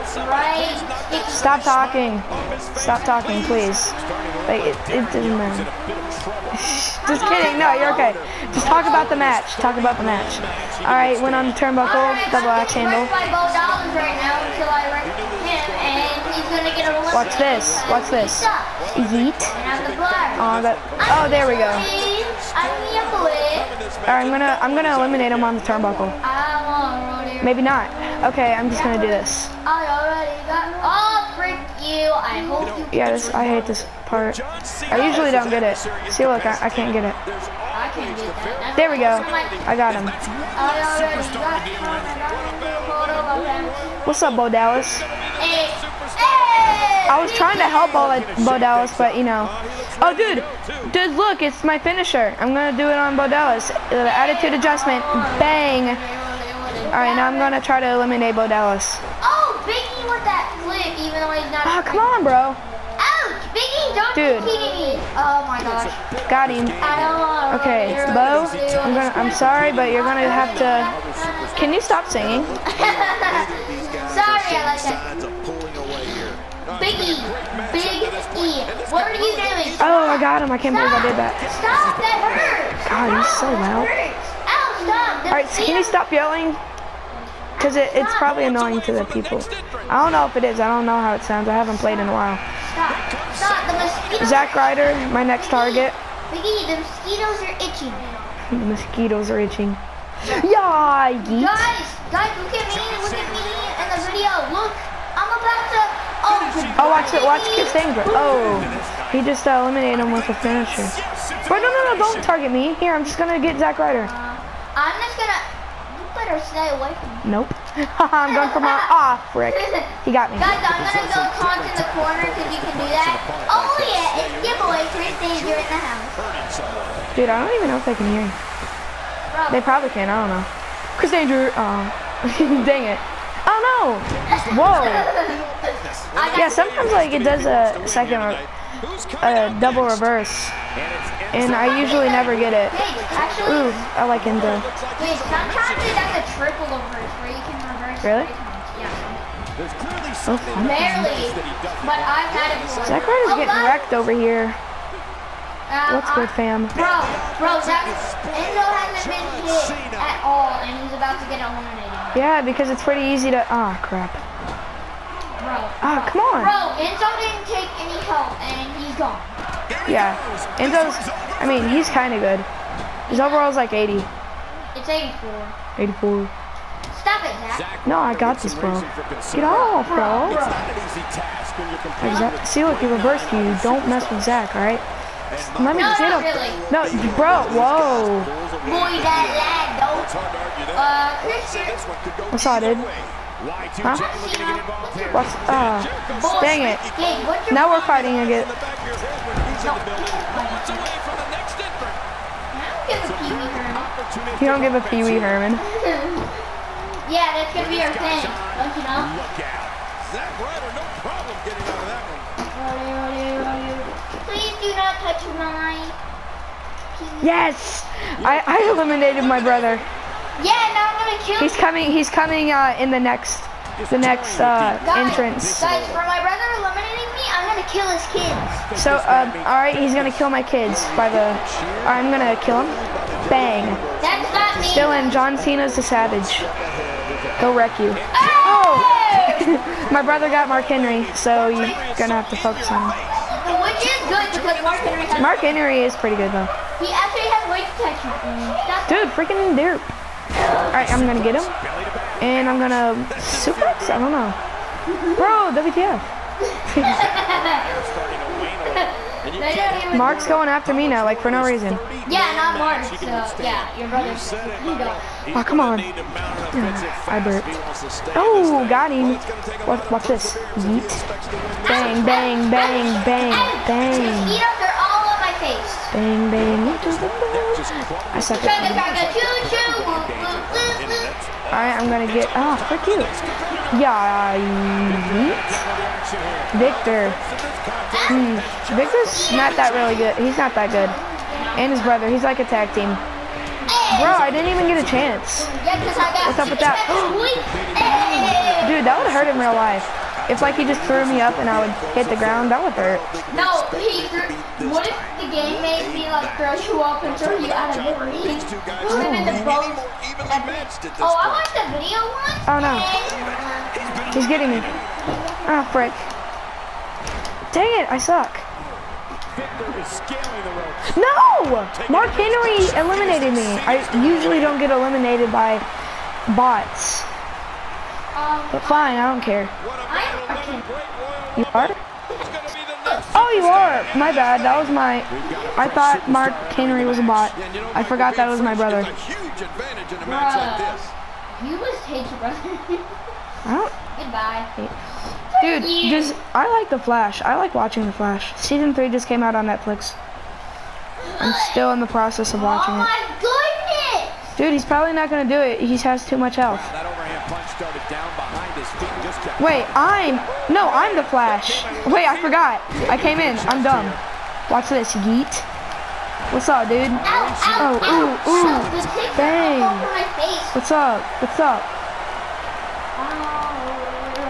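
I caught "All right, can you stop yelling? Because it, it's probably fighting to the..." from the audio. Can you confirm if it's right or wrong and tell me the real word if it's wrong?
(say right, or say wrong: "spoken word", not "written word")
wrong: "annoying", not "fighting".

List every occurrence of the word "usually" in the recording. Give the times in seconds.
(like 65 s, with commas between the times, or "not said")
35 s, 141 s, 324 s.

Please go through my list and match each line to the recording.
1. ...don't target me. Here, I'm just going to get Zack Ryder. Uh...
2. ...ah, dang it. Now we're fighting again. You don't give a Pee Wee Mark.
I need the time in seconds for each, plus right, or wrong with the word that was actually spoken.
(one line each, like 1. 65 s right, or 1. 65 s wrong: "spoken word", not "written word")
1. 111 s right
2. 195 s wrong: "Herman", not "Mark".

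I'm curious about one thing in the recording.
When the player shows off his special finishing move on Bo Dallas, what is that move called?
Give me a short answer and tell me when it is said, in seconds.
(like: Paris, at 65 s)
attitude adjustment, at 53 s.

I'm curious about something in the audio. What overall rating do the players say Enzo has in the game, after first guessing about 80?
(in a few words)
84.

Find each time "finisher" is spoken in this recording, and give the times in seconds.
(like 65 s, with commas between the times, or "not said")
51 s, 110 s.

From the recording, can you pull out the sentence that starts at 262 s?
Yeah, not Mark, so yeah, your brother.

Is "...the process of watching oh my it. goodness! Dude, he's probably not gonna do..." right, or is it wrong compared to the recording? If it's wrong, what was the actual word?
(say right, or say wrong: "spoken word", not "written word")
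right.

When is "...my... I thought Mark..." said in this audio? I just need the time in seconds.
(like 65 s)
334 s.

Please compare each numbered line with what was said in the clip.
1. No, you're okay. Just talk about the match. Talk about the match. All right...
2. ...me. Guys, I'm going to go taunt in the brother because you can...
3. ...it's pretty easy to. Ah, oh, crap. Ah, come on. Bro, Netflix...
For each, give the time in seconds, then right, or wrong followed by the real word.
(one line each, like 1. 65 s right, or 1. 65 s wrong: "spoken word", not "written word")
1. 7 s right
2. 120 s wrong: "corner", not "brother"
3. 162 s wrong: "Enzo", not "Netflix".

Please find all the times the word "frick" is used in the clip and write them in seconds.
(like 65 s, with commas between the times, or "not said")
31 s, 282 s, 315 s.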